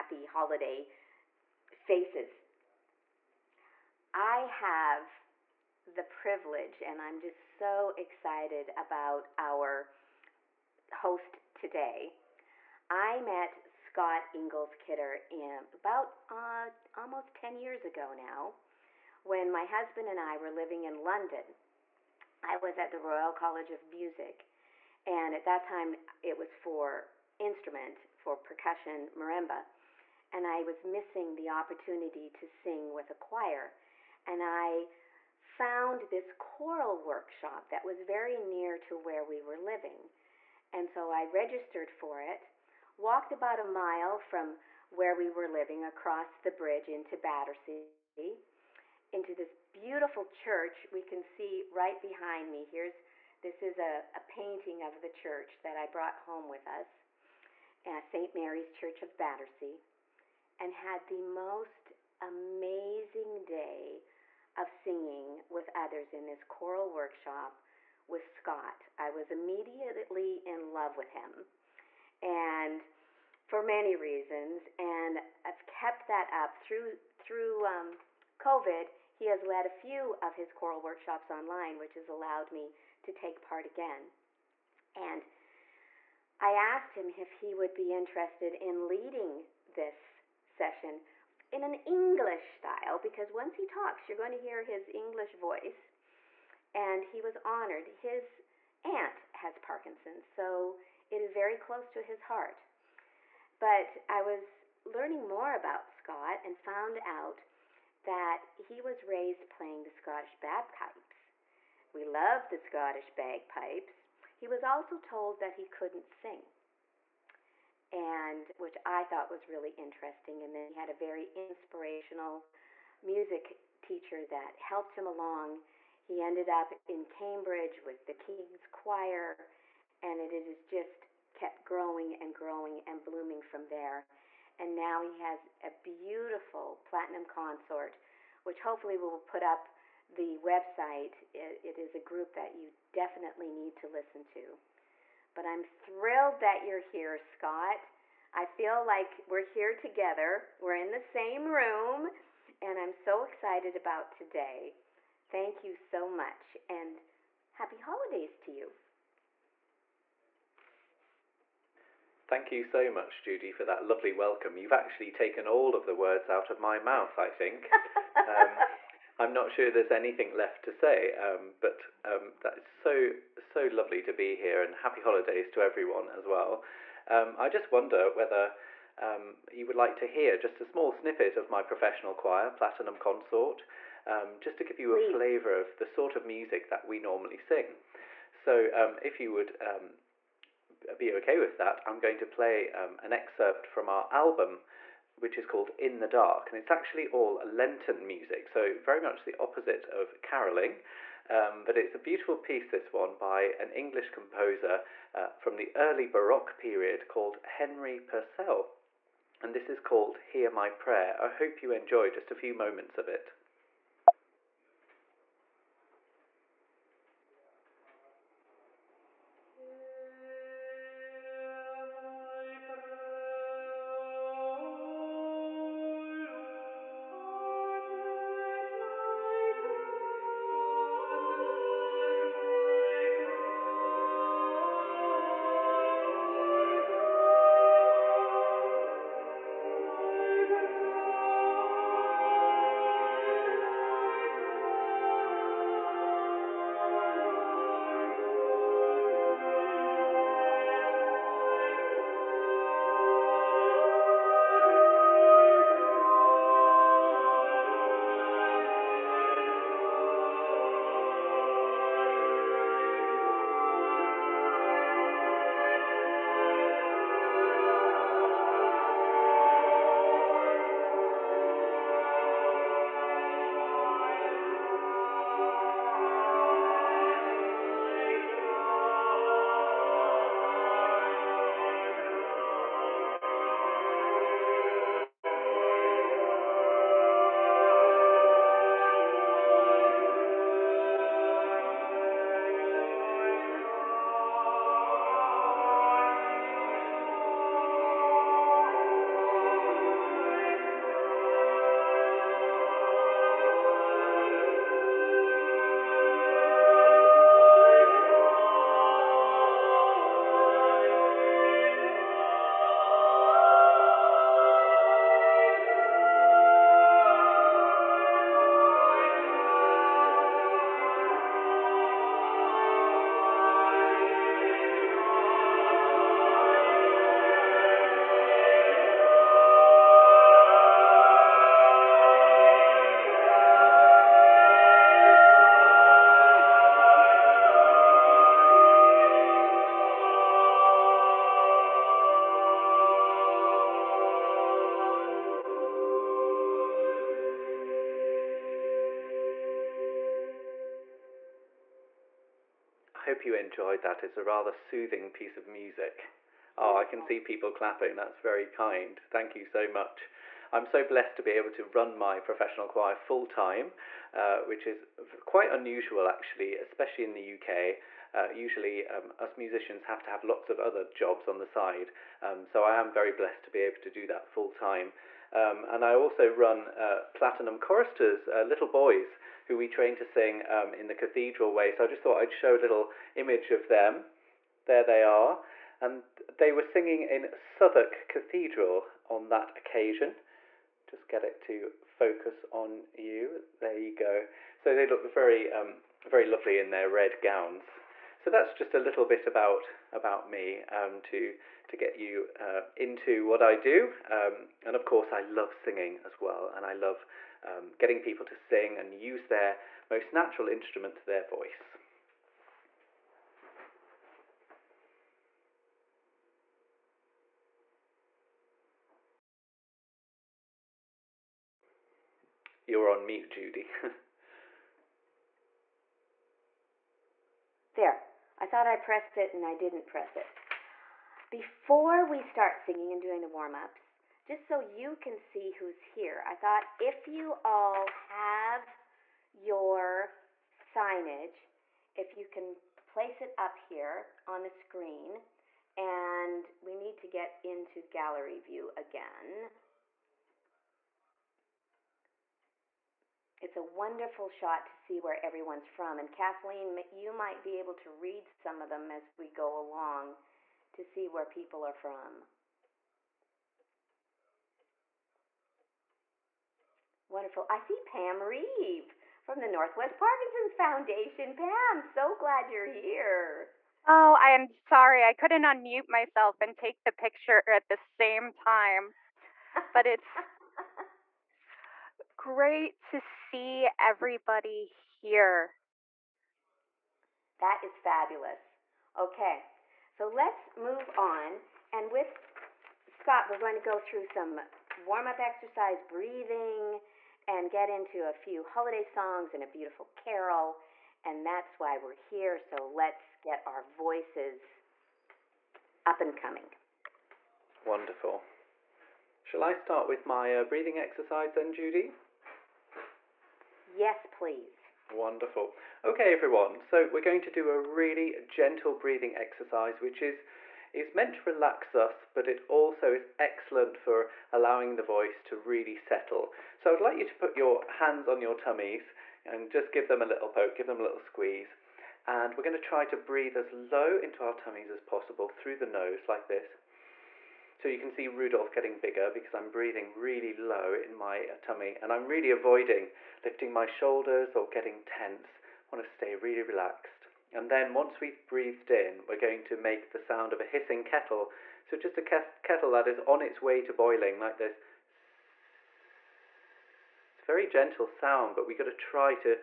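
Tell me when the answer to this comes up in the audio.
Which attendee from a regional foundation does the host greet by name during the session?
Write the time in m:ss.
7:47.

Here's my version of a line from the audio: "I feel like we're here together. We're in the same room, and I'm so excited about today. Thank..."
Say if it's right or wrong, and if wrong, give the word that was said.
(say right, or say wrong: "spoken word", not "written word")
right.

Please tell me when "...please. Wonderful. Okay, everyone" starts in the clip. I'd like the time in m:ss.
8:34.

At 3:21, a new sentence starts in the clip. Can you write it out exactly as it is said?
Um, but it's a beautiful piece, this one, by an English composer uh, from the early Baroque period called Henry Purcell.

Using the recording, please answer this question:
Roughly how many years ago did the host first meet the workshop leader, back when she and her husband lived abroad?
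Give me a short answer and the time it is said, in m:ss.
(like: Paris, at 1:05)
10 years, at 0:17.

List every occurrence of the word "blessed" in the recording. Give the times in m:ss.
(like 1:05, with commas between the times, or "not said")
6:00, 6:13.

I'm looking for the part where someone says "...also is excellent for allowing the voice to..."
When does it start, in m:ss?
8:42.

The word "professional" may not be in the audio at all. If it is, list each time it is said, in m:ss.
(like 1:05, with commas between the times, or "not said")
3:01, 6:02.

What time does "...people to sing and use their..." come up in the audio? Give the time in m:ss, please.
6:48.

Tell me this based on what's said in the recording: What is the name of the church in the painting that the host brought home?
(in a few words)
St. Mary's Church.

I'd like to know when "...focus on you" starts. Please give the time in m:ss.
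6:31.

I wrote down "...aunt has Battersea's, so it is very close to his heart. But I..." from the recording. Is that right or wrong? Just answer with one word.
wrong.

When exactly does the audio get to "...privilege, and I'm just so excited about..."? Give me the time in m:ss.
0:06.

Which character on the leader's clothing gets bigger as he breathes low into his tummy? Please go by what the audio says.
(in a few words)
Rudolph.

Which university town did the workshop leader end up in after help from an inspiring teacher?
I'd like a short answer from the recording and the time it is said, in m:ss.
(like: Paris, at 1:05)
Cambridge, at 2:07.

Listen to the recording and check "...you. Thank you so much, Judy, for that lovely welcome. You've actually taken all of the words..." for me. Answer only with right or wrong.
right.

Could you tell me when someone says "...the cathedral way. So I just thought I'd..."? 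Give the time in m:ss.
6:20.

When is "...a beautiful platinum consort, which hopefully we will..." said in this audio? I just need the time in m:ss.
2:15.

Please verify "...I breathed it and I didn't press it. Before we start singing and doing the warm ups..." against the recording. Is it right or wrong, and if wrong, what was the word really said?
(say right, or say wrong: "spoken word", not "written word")
wrong: "pressed", not "breathed".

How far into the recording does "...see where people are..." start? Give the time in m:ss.
7:40.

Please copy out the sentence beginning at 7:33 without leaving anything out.
it's a wonderful shot to see where everyone's from.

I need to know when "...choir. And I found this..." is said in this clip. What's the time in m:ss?
0:33.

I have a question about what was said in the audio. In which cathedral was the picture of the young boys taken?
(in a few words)
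Southwark Cathedral.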